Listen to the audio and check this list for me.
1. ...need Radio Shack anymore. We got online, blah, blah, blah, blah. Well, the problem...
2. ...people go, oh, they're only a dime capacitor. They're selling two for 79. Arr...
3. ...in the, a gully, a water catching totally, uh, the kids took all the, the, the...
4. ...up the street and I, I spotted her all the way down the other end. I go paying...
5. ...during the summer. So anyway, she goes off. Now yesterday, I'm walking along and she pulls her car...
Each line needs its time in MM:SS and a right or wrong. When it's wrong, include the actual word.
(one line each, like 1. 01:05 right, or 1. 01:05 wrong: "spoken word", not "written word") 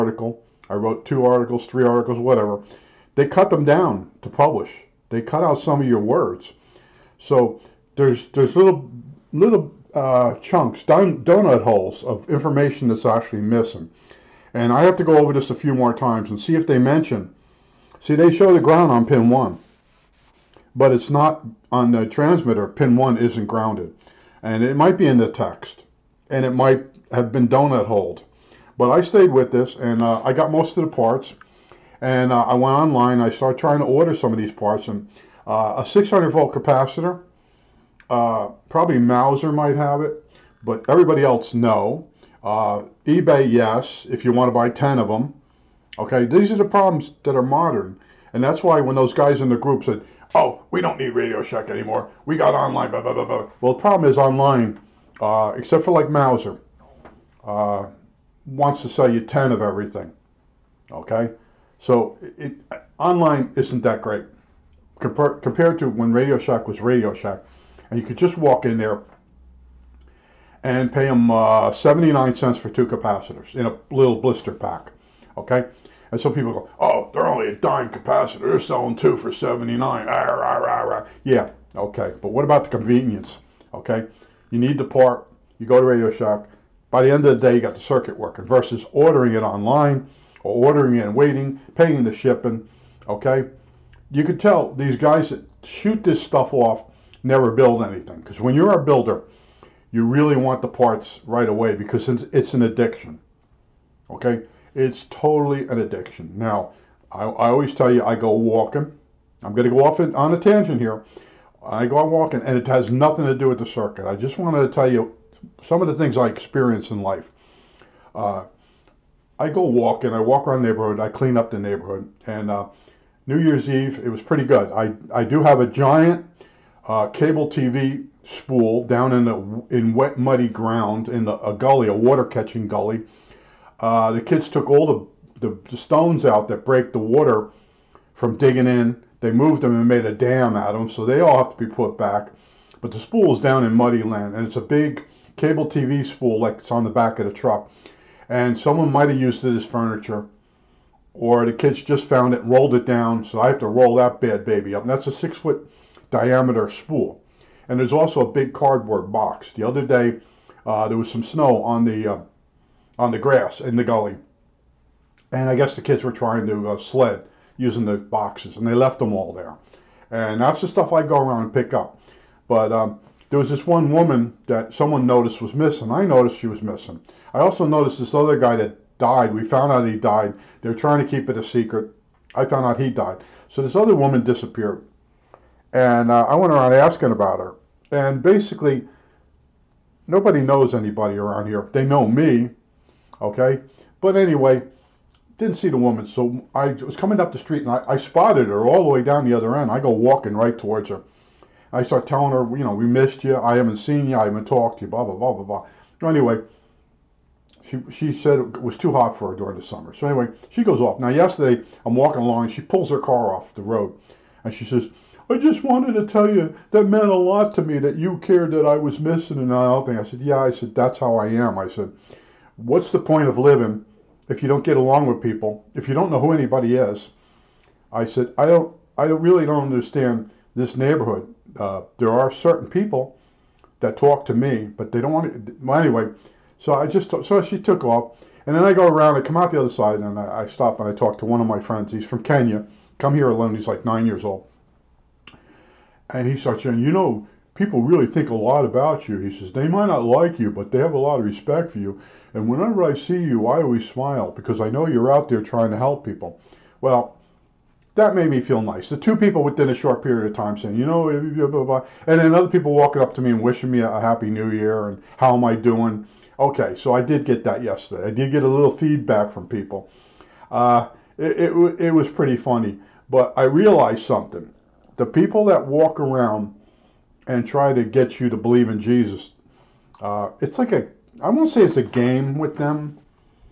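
1. 00:50 right
2. 01:16 right
3. 02:11 wrong: "gully", not "totally"
4. 03:17 wrong: "walking", not "paying"
5. 03:29 right.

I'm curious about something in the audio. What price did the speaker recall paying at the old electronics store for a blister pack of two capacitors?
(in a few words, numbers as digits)
79 cents.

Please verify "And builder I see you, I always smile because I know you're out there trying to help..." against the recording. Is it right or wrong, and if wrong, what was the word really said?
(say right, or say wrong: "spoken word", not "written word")
wrong: "whenever", not "builder".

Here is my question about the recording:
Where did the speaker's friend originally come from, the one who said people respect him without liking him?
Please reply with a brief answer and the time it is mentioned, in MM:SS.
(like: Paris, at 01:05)
Kenya, at 04:02.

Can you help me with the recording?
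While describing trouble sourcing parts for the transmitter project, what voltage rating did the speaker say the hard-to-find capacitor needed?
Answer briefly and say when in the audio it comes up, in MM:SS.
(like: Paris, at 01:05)
600 volt, at 00:35.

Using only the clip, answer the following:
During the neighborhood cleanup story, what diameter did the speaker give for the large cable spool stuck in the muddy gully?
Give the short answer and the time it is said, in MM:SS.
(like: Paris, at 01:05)
6 foot, at 02:35.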